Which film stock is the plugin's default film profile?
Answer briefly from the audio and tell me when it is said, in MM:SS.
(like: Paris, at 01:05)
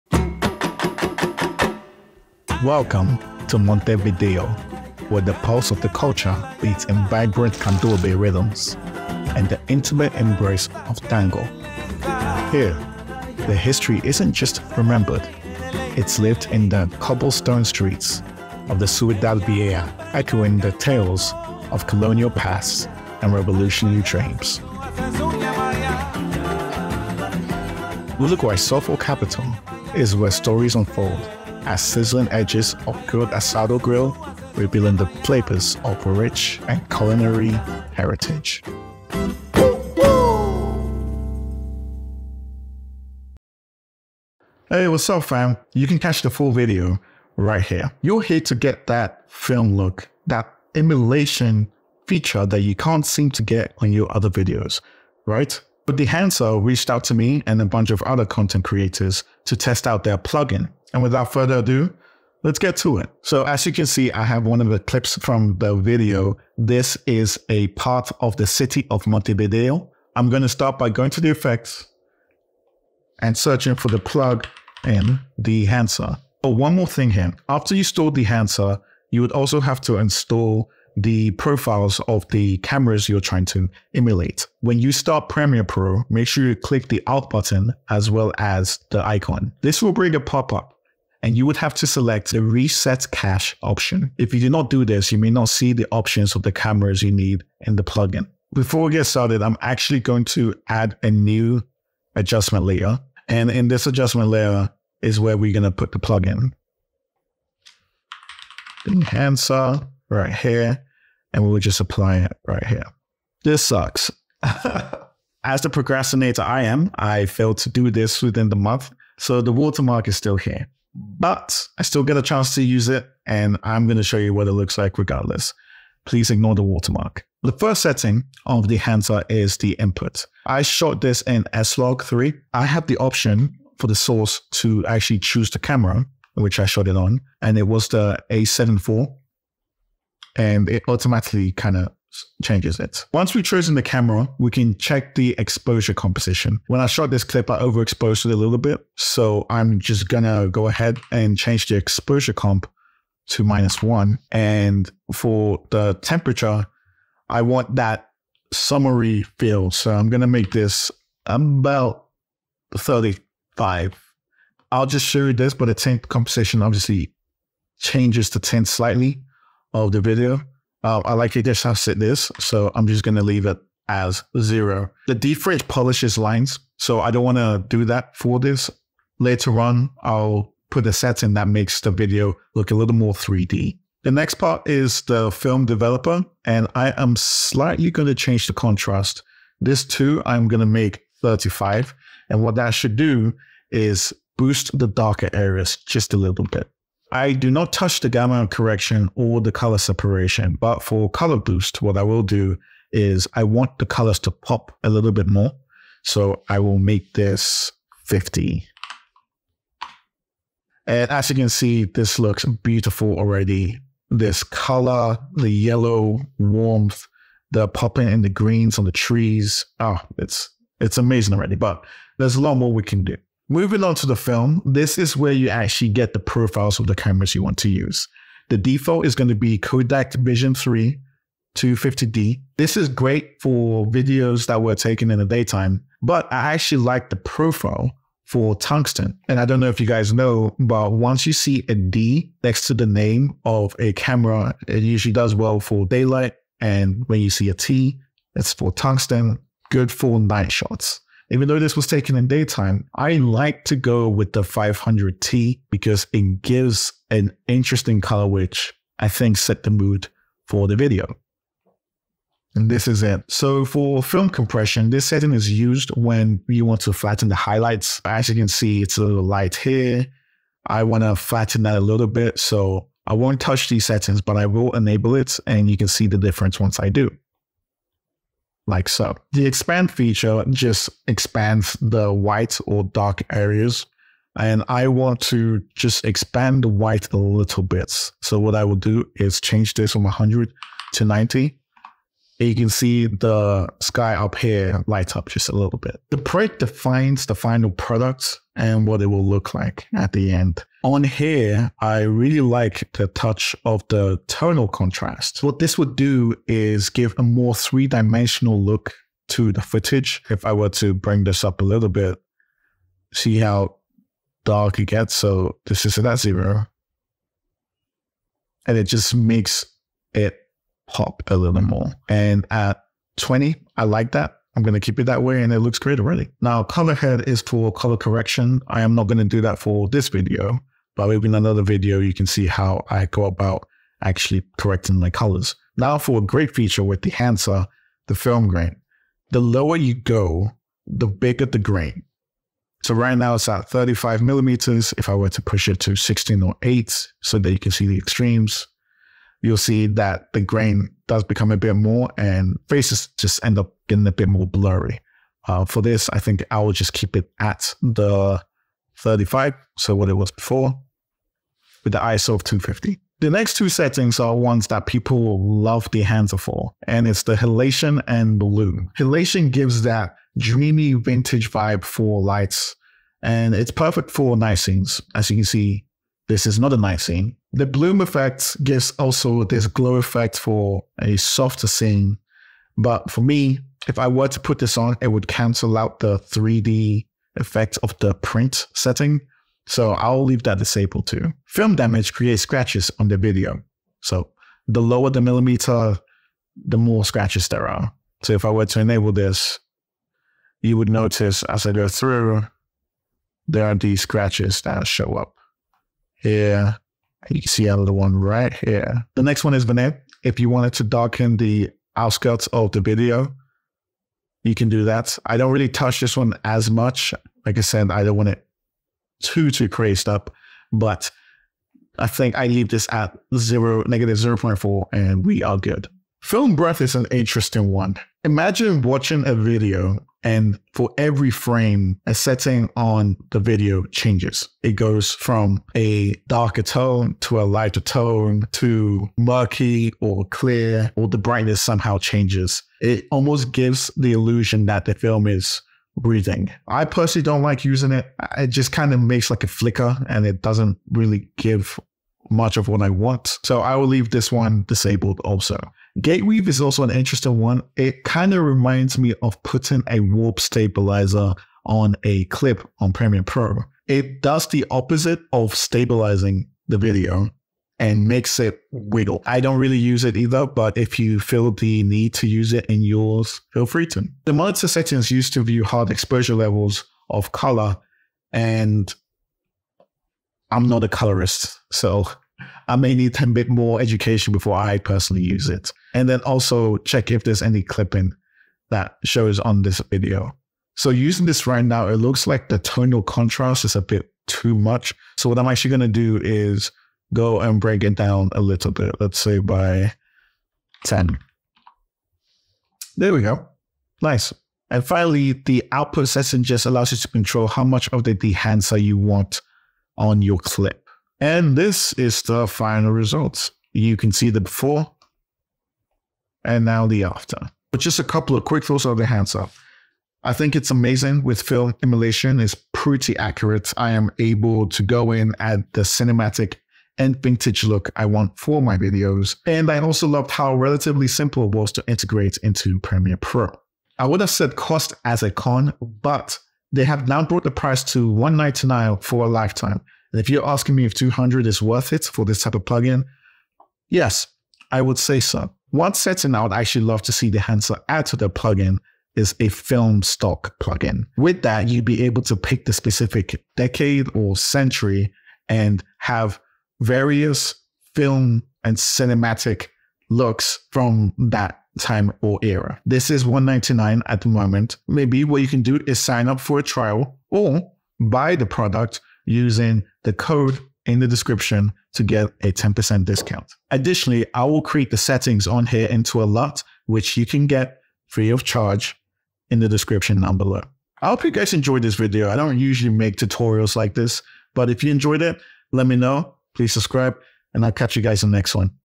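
Kodak Vision 3 250D, at 03:49.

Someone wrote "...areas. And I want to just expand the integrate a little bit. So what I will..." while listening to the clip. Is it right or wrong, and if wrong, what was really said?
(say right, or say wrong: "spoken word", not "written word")
wrong: "white", not "integrate".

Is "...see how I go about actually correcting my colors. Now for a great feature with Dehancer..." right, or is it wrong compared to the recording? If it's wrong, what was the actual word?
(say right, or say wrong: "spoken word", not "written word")
right.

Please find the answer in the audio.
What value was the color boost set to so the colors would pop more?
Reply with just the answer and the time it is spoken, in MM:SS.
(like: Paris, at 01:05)
50, at 03:28.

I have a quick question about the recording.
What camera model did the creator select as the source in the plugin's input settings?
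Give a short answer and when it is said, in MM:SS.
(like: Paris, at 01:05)
A7 IV, at 02:18.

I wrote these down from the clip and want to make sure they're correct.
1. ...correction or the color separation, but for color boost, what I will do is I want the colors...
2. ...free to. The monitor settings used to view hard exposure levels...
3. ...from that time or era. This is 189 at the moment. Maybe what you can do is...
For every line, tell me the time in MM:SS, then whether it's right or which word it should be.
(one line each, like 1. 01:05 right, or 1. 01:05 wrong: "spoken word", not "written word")
1. 03:18 right
2. 07:53 right
3. 09:20 wrong: "199", not "189".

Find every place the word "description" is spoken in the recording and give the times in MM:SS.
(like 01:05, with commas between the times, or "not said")
09:31, 09:39.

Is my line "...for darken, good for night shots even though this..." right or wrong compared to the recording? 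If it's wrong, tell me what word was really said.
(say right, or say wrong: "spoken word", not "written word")
wrong: "tungsten", not "darken".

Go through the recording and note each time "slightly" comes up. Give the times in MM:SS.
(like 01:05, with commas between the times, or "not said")
02:48, 03:07.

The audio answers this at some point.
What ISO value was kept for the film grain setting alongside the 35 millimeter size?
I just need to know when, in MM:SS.
06:02.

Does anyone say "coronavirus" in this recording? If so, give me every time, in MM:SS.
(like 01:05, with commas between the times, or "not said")
not said.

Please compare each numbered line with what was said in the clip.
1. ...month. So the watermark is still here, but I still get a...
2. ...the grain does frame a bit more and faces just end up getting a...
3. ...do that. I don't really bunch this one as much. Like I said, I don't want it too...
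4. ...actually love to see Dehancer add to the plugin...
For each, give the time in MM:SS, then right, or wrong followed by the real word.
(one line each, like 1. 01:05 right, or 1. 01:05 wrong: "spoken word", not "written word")
1. 01:58 right
2. 05:50 wrong: "become", not "frame"
3. 06:54 wrong: "touch", not "bunch"
4. 09:06 right.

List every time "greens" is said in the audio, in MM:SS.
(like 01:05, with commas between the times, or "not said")
03:38.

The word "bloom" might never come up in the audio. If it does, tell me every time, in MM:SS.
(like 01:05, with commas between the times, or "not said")
06:08, 06:17.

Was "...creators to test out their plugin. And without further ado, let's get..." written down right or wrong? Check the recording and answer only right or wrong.
right.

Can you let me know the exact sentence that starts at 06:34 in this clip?
So the lower the millimeter, the more scratches there are.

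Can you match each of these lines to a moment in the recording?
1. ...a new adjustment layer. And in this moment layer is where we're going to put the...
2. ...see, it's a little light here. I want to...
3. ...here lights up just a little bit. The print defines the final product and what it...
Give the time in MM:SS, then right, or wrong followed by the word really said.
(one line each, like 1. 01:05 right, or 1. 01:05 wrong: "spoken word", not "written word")
1. 01:41 wrong: "adjustment", not "moment"
2. 04:28 right
3. 04:54 right.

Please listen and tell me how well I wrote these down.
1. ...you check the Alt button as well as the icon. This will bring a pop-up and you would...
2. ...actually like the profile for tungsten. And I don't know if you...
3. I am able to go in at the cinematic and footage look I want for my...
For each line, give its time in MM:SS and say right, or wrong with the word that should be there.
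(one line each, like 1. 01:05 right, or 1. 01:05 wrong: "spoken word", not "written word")
1. 01:26 wrong: "click", not "check"
2. 03:56 right
3. 08:43 wrong: "vintage", not "footage".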